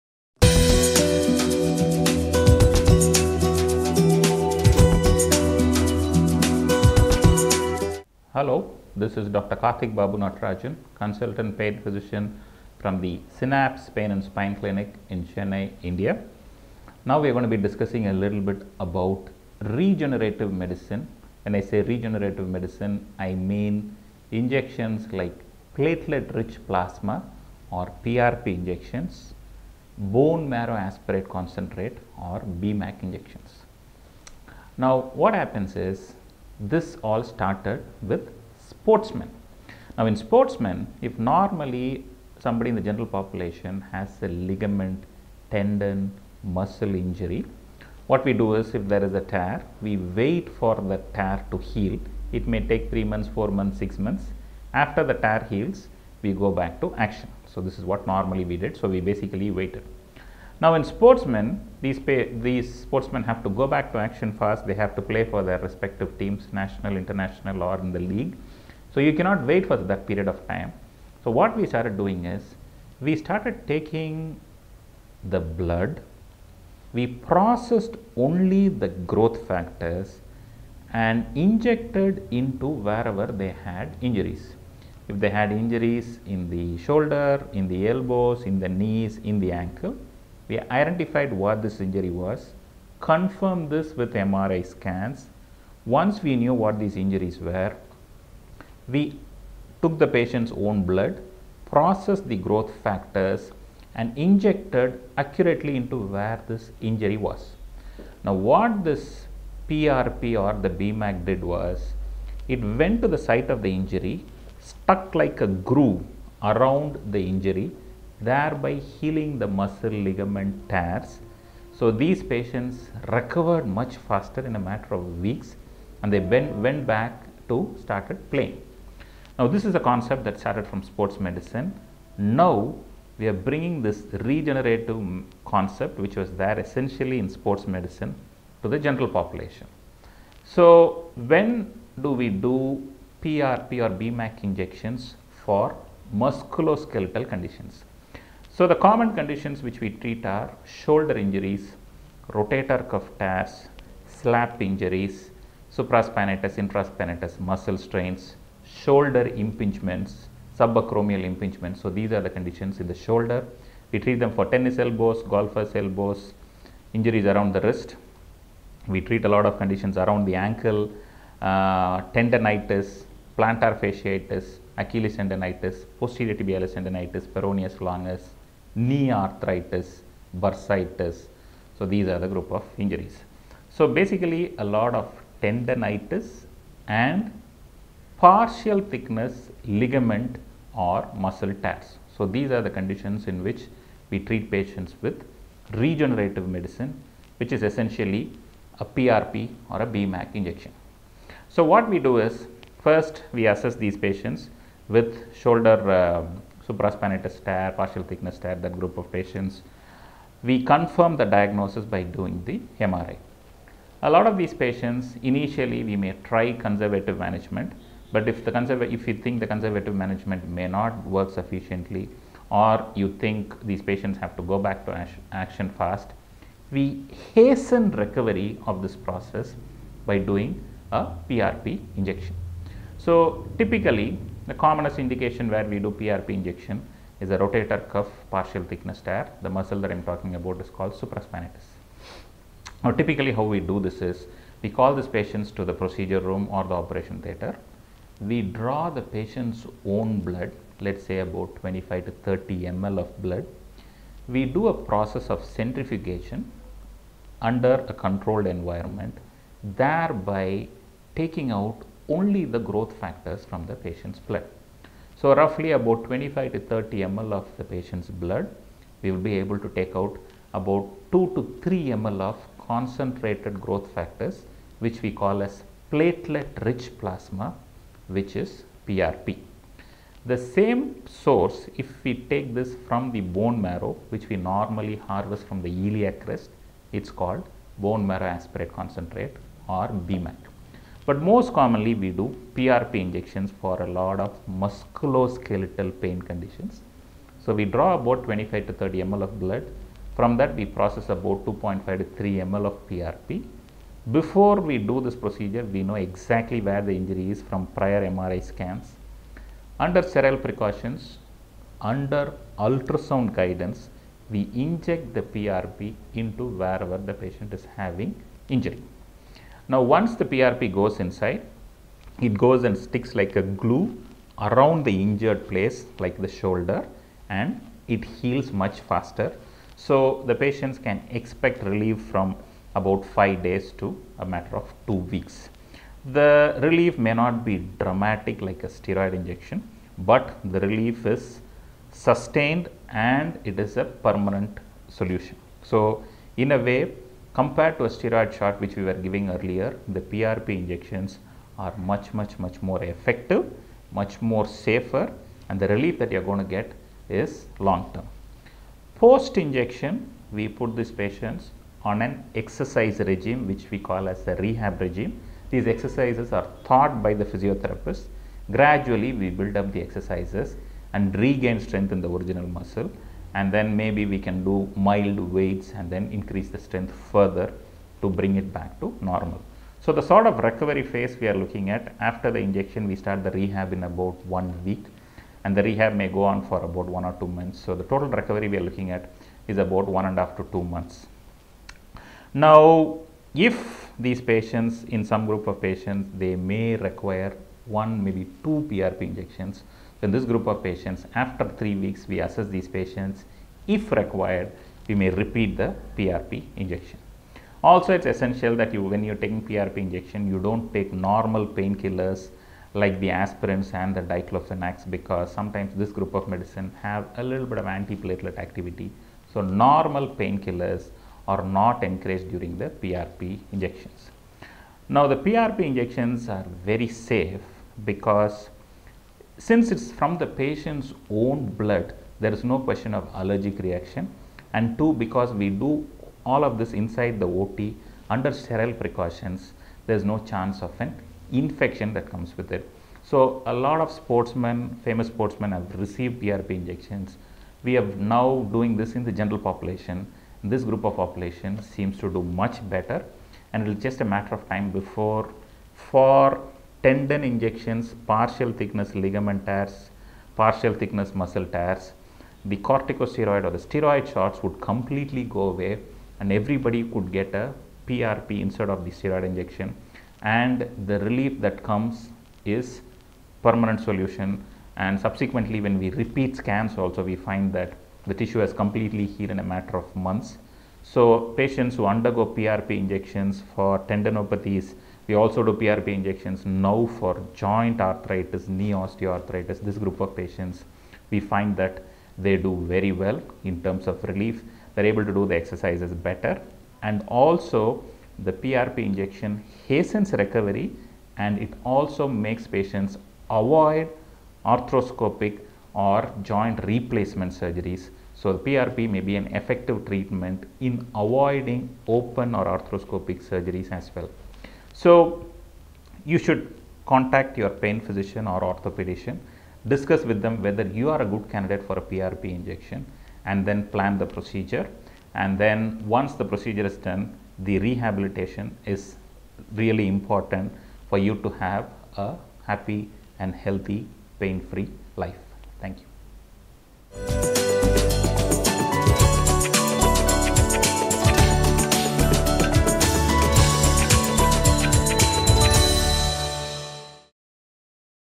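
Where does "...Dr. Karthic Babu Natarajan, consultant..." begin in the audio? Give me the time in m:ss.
0:09.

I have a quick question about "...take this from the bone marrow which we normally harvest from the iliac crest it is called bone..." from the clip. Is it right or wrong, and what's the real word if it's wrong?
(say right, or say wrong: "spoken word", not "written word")
right.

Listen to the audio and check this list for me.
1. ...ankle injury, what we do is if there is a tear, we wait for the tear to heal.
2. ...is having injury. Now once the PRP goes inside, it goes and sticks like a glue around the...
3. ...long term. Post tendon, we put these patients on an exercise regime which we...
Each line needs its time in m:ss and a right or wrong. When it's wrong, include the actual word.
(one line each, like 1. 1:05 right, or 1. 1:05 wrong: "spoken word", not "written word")
1. 0:46 wrong: "muscle", not "ankle"
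2. 5:17 right
3. 5:57 wrong: "injection", not "tendon".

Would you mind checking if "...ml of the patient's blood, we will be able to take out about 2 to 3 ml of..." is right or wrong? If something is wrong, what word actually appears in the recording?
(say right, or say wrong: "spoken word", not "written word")
right.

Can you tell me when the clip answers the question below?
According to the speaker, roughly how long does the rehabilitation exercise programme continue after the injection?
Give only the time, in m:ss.
6:26.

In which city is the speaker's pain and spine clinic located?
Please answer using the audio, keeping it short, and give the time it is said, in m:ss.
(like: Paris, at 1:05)
Chennai, at 0:15.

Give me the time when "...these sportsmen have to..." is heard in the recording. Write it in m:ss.
1:02.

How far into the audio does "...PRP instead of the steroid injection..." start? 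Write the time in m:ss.
7:47.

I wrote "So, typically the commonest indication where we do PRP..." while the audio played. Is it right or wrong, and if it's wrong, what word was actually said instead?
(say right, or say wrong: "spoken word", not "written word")
right.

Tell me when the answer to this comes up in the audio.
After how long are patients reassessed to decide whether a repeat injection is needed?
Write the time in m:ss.
6:41.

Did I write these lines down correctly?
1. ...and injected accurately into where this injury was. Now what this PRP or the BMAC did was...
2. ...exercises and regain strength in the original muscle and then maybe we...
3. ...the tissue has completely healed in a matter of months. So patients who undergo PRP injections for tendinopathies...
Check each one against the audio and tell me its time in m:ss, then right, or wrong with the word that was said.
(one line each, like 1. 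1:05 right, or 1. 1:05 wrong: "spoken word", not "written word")
1. 1:43 right
2. 6:09 right
3. 7:58 right.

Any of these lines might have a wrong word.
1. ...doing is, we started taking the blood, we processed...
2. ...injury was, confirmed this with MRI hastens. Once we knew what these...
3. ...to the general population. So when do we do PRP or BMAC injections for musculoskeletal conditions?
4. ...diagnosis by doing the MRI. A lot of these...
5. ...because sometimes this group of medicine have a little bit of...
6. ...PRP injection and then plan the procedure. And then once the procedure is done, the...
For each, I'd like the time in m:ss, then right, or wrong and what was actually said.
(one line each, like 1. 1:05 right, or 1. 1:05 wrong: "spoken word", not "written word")
1. 1:11 right
2. 1:31 wrong: "scans", not "hastens"
3. 2:18 right
4. 3:31 right
5. 6:54 right
6. 8:41 right.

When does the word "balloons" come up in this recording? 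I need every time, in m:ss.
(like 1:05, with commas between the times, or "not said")
not said.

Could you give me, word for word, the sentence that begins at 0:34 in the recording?
Now what happens is this all started with sportsmen.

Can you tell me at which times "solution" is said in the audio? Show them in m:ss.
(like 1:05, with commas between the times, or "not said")
5:44, 7:53.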